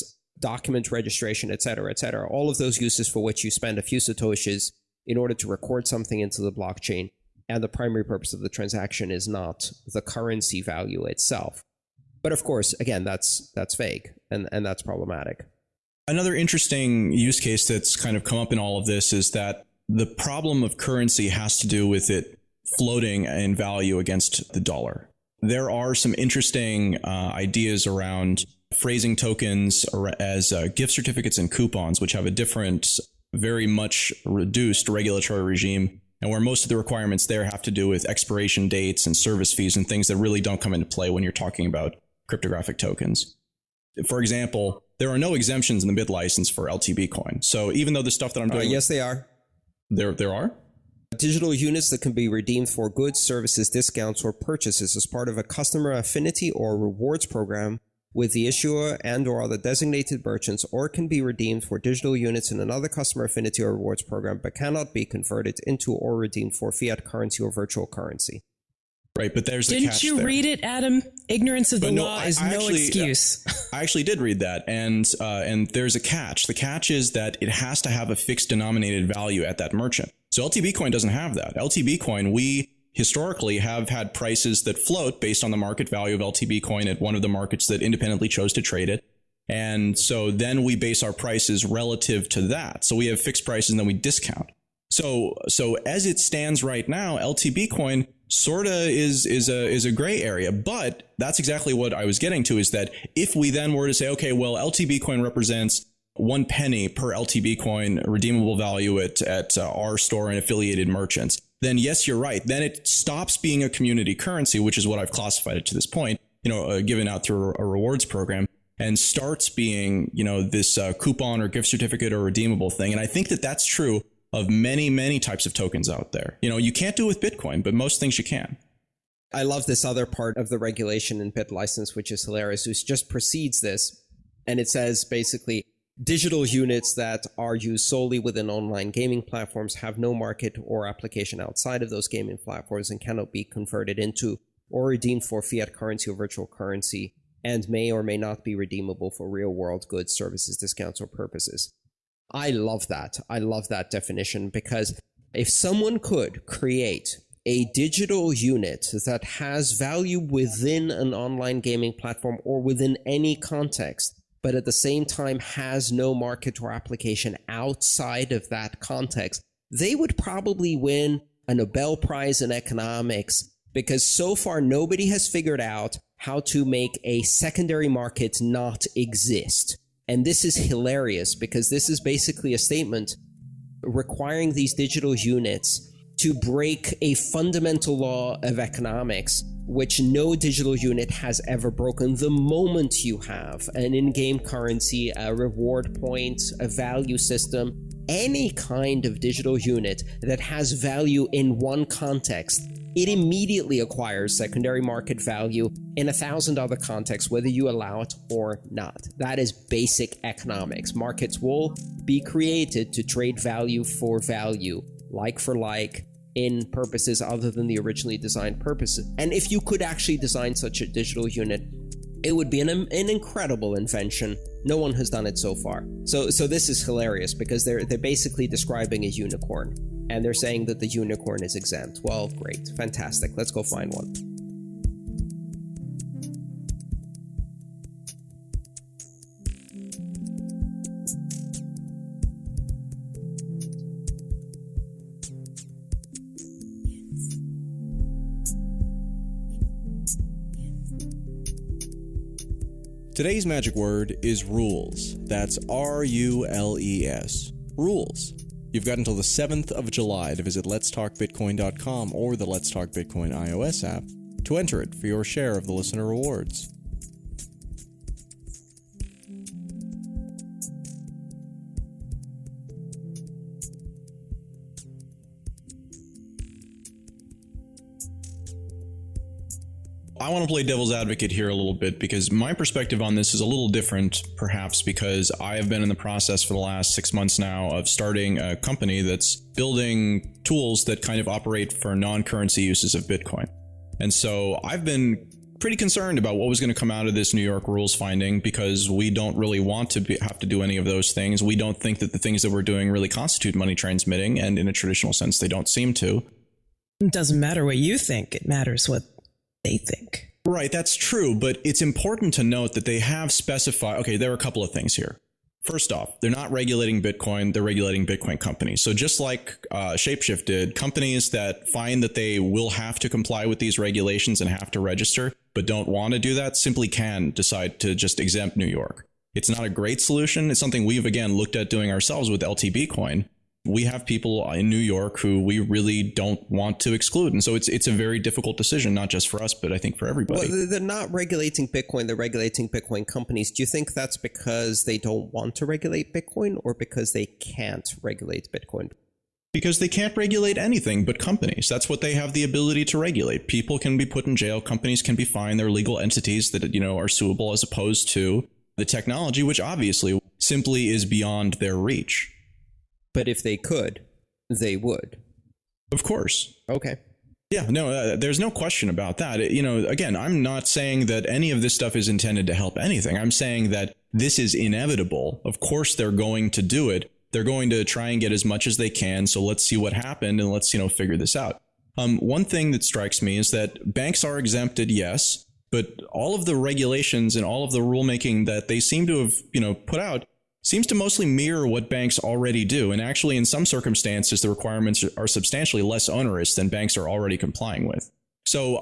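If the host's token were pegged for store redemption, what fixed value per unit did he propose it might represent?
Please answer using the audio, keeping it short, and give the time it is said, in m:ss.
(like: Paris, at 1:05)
one penny, at 1:46.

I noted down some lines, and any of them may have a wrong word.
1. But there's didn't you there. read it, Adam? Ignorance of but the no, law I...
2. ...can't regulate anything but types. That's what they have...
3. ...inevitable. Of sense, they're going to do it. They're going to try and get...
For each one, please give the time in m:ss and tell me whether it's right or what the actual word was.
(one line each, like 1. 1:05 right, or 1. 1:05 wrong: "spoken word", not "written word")
1. 1:09 right
2. 5:49 wrong: "companies", not "types"
3. 6:14 wrong: "course", not "sense".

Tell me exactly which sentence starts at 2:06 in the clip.
You know, you can't do with Bitcoin, but most things you can.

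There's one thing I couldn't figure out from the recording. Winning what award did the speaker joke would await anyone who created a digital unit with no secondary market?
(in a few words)
Nobel Prize in economics.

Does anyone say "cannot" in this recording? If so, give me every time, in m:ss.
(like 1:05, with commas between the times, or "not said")
1:04, 2:23.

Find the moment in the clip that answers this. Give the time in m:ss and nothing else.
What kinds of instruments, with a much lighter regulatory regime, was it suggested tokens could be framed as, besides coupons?
0:30.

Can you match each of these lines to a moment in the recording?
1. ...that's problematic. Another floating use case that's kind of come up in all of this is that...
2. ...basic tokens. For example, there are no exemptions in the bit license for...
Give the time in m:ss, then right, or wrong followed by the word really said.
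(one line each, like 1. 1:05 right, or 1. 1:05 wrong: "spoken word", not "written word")
1. 0:14 wrong: "interesting", not "floating"
2. 0:42 wrong: "cryptographic", not "basic".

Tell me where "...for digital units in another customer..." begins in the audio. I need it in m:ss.
1:01.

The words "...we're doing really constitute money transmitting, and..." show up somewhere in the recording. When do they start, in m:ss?
5:02.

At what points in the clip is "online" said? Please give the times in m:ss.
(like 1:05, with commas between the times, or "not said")
2:18, 2:41.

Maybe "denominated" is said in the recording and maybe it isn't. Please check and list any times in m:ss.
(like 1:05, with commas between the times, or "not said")
1:18.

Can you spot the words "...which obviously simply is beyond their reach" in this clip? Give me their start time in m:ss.
5:59.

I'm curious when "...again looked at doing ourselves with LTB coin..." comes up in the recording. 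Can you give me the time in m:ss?
5:31.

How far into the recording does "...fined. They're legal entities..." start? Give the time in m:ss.
5:55.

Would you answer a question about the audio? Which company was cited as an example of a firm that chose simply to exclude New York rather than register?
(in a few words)
Shapeshift.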